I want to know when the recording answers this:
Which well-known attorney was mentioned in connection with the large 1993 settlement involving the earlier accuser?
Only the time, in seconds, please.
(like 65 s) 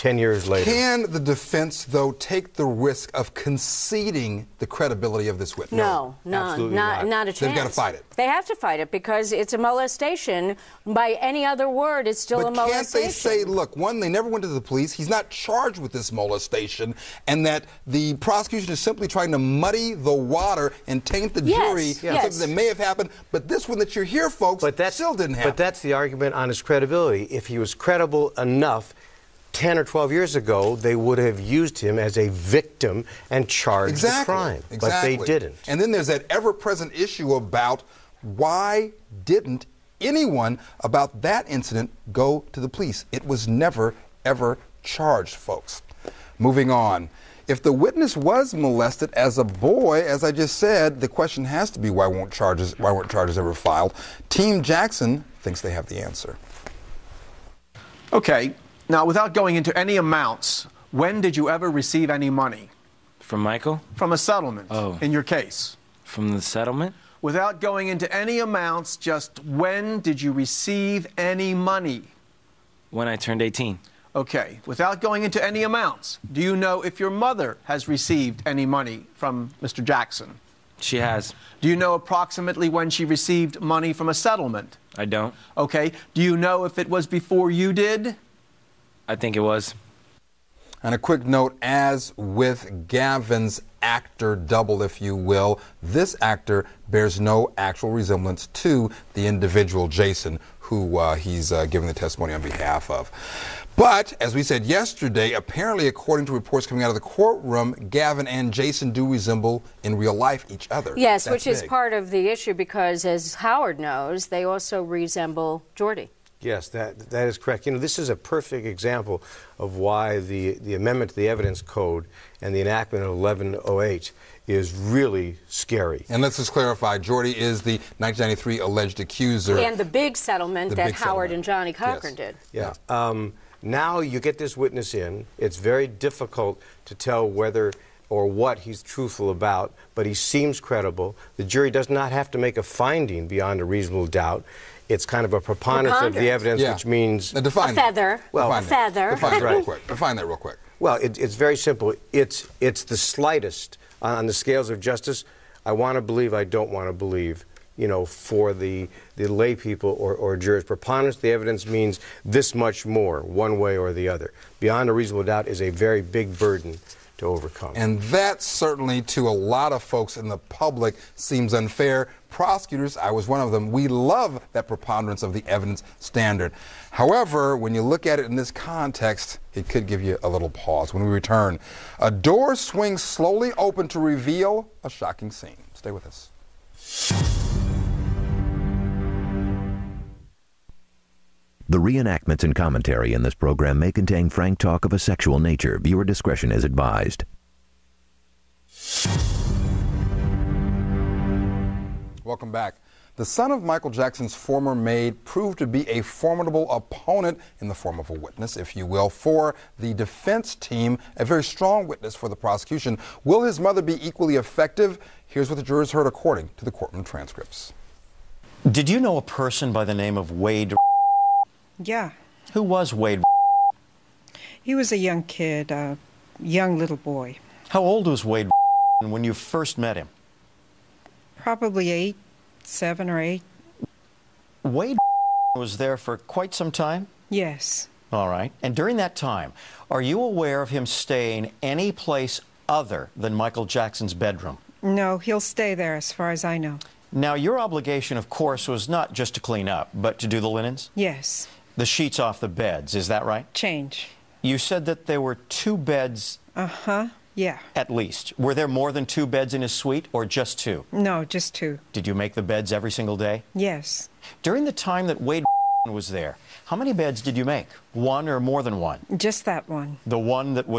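131 s.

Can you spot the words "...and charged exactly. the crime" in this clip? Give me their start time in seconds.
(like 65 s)
33 s.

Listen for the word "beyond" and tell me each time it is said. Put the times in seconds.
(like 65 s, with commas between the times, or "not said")
143 s, 164 s.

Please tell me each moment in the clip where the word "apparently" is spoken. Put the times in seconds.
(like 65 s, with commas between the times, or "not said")
105 s.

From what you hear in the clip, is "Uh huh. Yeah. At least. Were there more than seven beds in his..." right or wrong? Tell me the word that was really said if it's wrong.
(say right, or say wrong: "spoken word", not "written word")
wrong: "two", not "seven".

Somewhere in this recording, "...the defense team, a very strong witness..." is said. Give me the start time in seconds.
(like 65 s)
209 s.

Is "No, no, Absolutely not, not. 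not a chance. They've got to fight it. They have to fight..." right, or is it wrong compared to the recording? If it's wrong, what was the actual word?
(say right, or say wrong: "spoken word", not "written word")
right.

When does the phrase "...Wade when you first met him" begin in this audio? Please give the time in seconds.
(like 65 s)
228 s.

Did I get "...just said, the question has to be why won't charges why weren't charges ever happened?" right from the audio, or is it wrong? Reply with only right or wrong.
wrong.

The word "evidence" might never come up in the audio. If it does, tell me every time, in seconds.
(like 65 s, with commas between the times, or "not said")
121 s, 146 s, 161 s, 175 s.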